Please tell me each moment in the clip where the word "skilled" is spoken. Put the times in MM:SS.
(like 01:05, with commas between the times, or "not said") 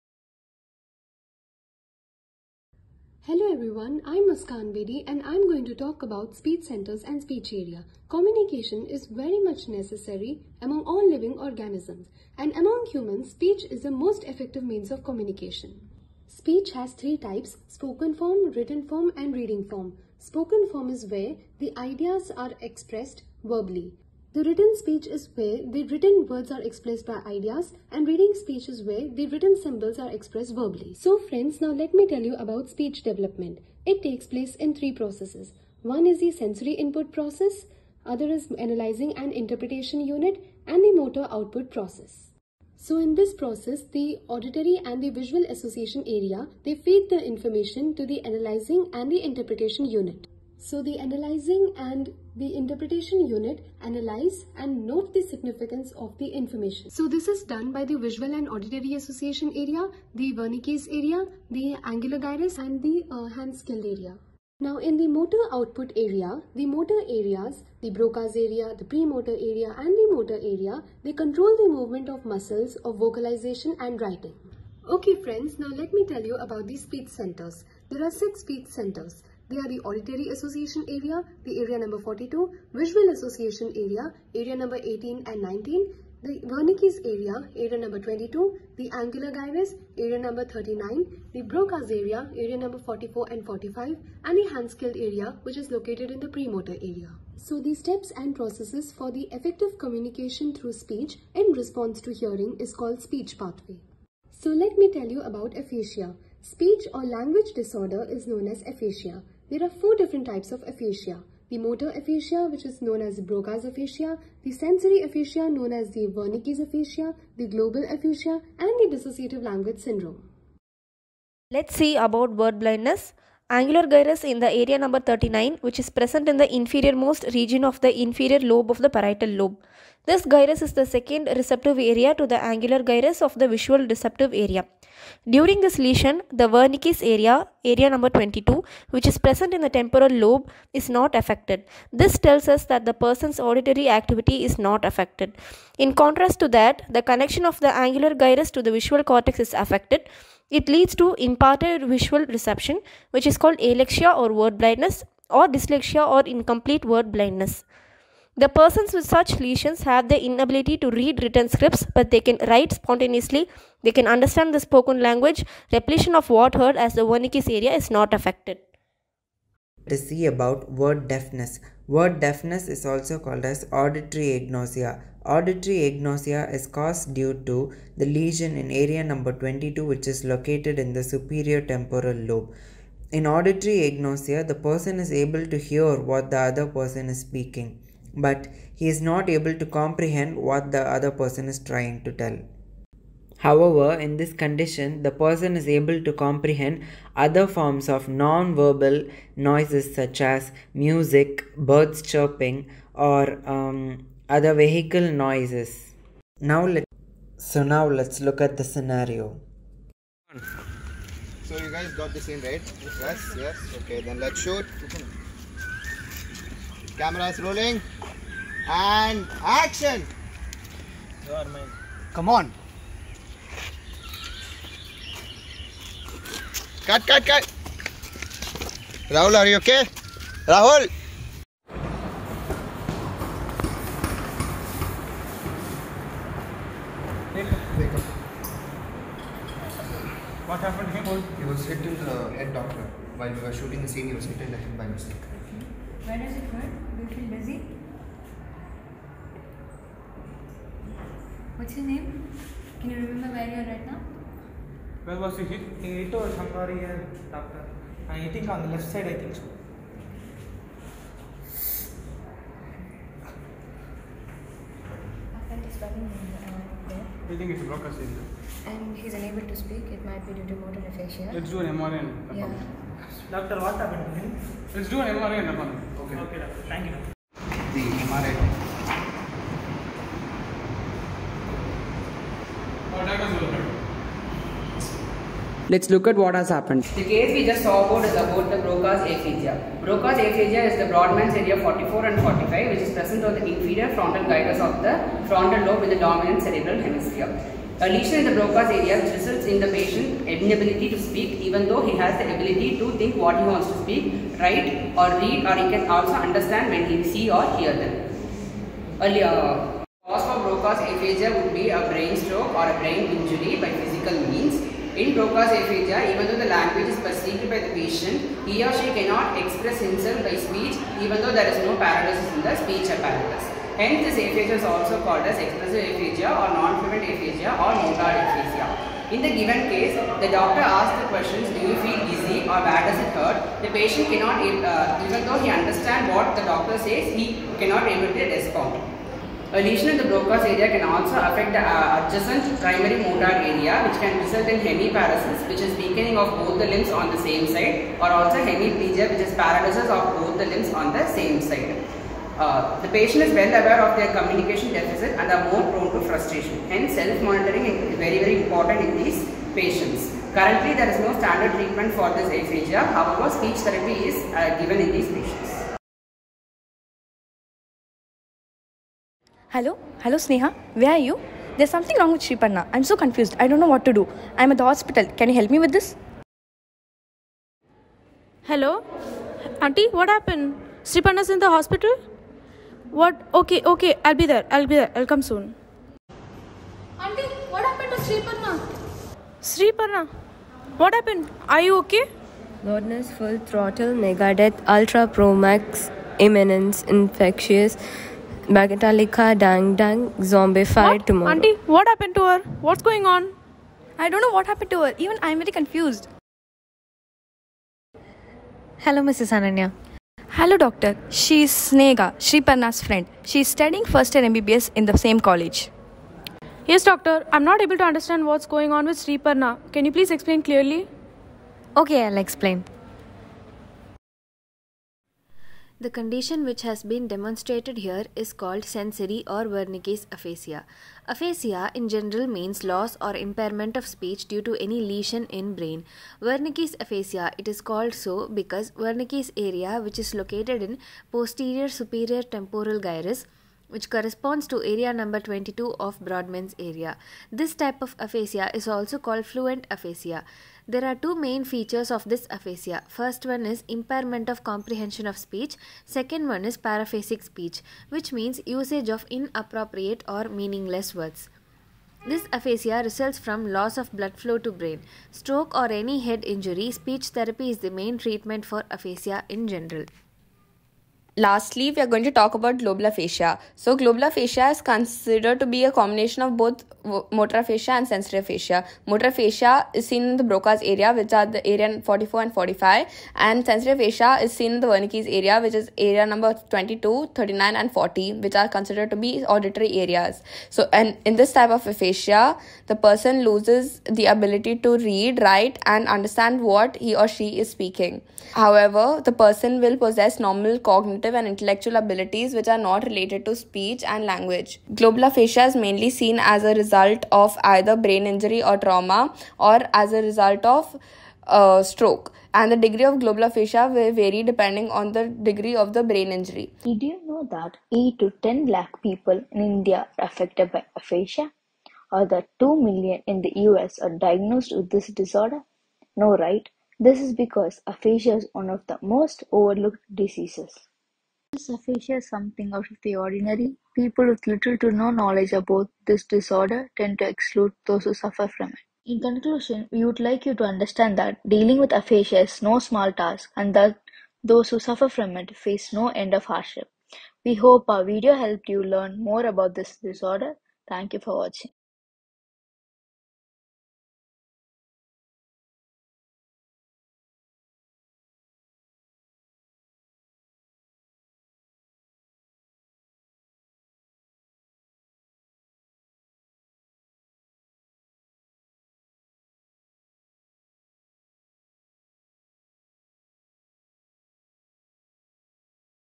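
01:03, 01:34.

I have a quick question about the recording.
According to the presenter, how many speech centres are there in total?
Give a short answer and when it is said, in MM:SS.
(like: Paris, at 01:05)
6, at 01:18.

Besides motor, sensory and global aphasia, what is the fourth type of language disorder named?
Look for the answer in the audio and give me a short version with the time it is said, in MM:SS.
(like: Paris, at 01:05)
dissociative language syndrome, at 01:58.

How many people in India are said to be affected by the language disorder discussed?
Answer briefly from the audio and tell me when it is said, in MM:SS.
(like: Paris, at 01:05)
8 to 10 lakh, at 08:37.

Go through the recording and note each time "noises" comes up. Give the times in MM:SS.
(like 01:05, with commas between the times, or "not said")
03:19, 03:25.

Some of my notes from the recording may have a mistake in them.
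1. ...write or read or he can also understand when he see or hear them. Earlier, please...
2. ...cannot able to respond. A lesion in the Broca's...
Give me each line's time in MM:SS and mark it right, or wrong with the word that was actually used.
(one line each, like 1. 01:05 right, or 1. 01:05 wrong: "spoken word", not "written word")
1. 05:04 wrong: "cause", not "please"
2. 05:37 right.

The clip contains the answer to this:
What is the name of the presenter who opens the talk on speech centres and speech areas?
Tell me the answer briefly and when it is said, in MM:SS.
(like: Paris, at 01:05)
Muskan Bedi, at 00:04.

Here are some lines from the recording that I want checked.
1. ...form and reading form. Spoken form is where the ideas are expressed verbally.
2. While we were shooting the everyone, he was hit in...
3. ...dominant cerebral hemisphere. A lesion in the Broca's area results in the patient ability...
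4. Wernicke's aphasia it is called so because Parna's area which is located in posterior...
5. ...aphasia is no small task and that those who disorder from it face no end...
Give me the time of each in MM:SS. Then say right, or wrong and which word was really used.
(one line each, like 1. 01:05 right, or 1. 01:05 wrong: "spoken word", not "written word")
1. 00:18 right
2. 04:03 wrong: "scene", not "everyone"
3. 04:56 wrong: "inability", not "ability"
4. 07:16 wrong: "Wernicke", not "Parna"
5. 09:01 wrong: "suffer", not "disorder".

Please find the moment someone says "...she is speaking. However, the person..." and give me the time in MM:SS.
08:17.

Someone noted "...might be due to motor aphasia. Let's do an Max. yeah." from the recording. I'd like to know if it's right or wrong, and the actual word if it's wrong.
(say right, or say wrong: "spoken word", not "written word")
wrong: "MRI", not "Max".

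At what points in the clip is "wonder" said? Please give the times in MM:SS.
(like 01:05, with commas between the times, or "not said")
not said.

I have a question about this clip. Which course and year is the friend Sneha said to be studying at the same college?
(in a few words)
first year MBBS.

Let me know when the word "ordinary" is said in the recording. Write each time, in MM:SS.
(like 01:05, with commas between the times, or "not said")
08:52.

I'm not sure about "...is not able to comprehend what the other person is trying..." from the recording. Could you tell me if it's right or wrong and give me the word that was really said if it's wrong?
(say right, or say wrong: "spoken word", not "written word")
right.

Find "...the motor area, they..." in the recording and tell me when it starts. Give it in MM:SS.
01:09.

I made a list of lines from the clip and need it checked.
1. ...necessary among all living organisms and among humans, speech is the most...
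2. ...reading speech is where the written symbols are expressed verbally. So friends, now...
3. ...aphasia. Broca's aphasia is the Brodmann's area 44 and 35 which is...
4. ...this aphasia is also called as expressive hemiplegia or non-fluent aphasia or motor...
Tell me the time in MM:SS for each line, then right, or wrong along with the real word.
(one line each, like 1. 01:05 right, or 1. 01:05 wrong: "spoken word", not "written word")
1. 00:09 right
2. 00:28 right
3. 04:49 wrong: "45", not "35"
4. 05:24 wrong: "aphasia", not "hemiplegia".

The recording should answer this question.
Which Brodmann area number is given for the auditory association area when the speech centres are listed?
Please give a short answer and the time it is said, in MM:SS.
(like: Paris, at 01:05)
42, at 01:21.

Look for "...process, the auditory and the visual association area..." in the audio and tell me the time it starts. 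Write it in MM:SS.
00:43.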